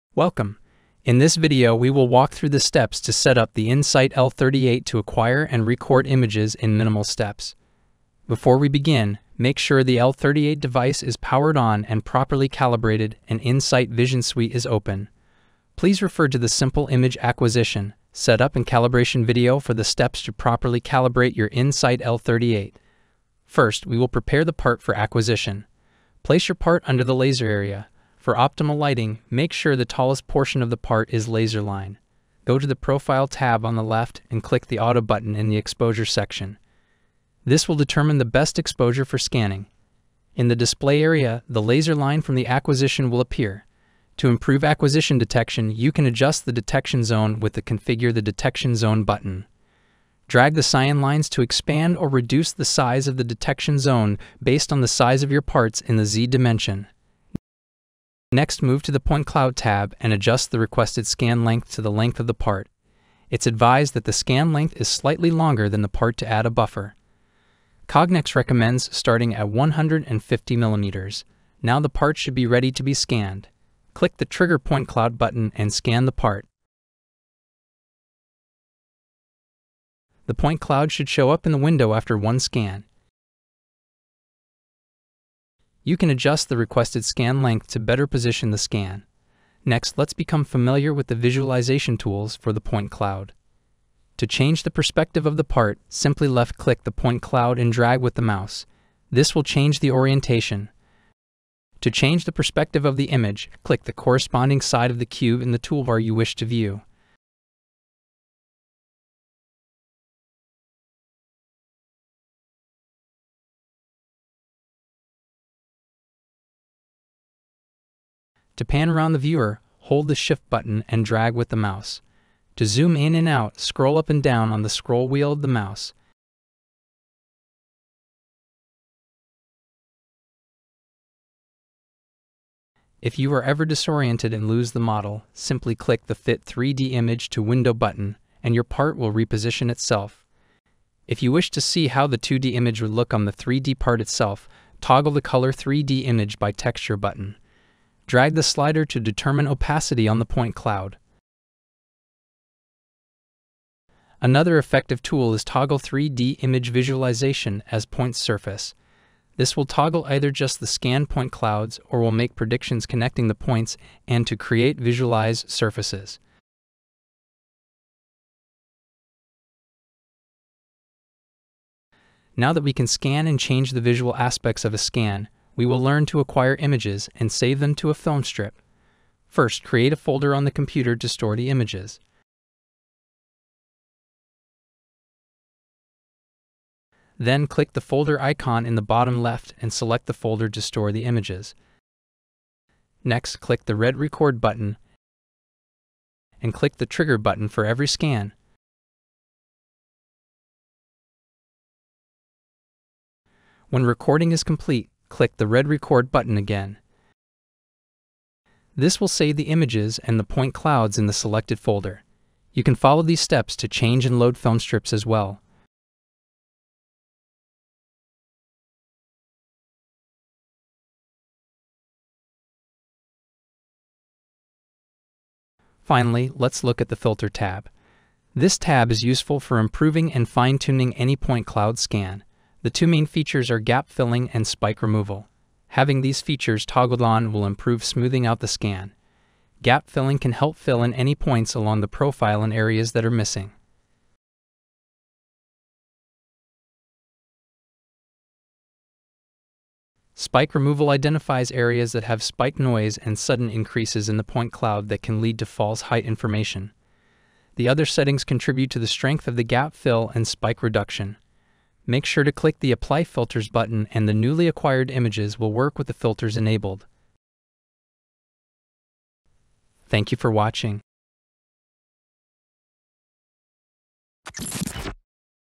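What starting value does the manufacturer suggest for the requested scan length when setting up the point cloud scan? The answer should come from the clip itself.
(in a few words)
150 millimeters.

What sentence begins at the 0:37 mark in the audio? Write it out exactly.
This will determine the best exposure for scanning.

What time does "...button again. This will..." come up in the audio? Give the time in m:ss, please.
3:26.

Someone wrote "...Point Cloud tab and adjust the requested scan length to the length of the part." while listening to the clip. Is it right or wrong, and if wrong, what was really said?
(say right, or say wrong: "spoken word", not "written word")
right.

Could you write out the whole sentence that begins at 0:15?
Please refer to the Simple Image Acquisition, Setup and Calibration video for the steps to properly calibrate your In-Sight L38.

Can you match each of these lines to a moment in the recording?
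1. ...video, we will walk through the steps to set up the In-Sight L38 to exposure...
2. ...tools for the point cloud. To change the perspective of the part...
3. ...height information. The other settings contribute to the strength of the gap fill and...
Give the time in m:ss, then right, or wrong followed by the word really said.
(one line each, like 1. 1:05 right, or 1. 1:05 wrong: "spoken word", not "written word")
1. 0:01 wrong: "acquire", not "exposure"
2. 1:31 right
3. 4:15 right.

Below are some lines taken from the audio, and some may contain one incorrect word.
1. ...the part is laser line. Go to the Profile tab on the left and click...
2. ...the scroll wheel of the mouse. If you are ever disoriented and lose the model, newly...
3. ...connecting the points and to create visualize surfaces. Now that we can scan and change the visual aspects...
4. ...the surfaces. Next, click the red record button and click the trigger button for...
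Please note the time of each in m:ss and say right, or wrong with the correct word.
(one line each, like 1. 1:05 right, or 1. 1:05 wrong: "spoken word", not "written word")
1. 0:30 right
2. 2:04 wrong: "simply", not "newly"
3. 2:42 right
4. 3:10 wrong: "images", not "surfaces".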